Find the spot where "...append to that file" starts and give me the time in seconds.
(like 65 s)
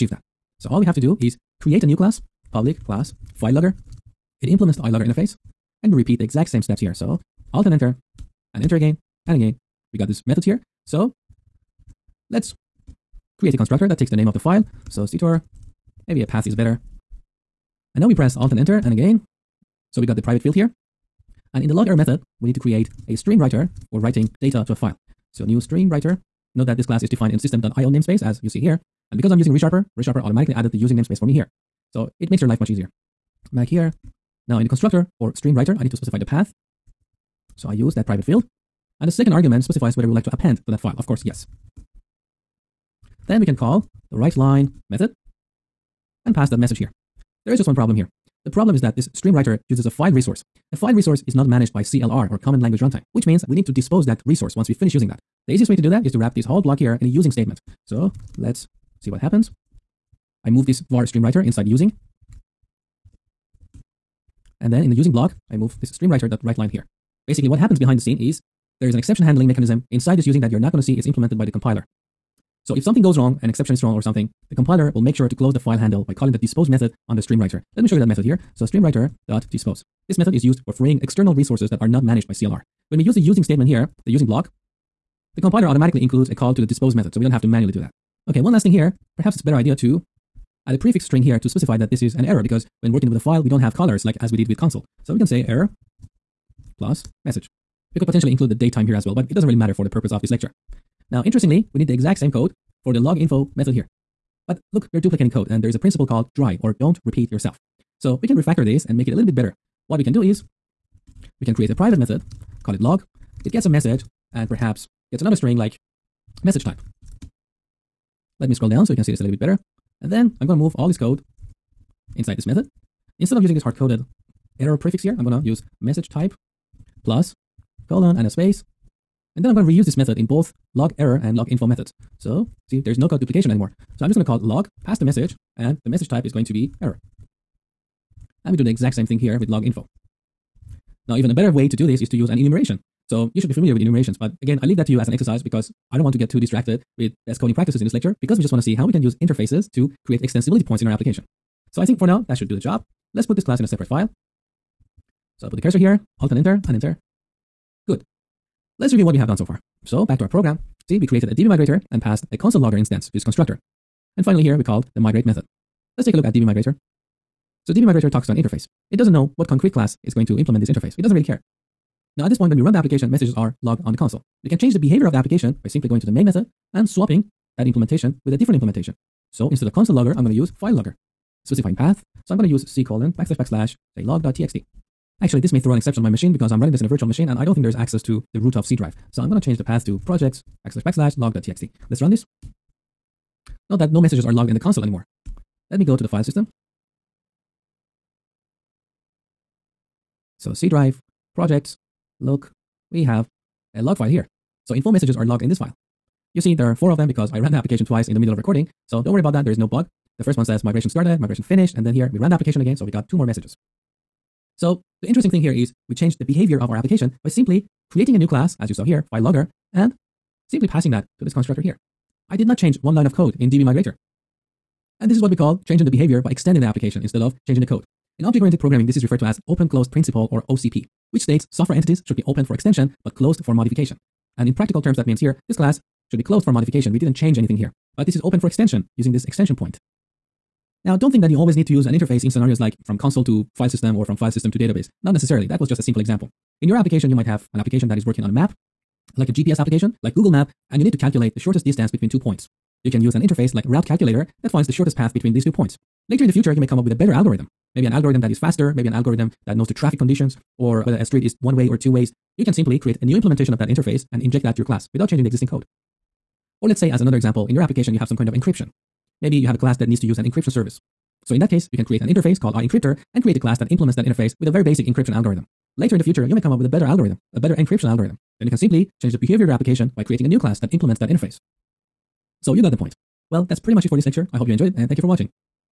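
40 s.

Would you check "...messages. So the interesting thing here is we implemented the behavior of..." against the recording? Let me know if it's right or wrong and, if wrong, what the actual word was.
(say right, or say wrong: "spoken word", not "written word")
wrong: "changed", not "implemented".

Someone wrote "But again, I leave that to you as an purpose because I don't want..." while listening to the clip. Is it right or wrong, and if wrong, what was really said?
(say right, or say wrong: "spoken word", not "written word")
wrong: "exercise", not "purpose".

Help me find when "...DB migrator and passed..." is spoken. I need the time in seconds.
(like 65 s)
161 s.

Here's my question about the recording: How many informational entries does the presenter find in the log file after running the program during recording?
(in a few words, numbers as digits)
4.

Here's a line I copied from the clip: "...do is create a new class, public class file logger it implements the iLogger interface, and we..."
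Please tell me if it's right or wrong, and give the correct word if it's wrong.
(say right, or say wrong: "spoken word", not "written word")
right.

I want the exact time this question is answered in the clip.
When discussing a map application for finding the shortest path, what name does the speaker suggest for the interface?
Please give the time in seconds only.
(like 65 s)
253 s.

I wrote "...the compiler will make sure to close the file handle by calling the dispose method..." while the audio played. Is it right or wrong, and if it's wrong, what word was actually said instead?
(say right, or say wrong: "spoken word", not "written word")
right.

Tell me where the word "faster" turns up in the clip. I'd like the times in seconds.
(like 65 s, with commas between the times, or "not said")
258 s.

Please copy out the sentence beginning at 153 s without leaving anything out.
Let's put this class in a separate file.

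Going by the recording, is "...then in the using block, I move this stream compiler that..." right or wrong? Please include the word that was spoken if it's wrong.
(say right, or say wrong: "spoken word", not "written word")
wrong: "writer", not "compiler".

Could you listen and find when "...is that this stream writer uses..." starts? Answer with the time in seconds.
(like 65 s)
48 s.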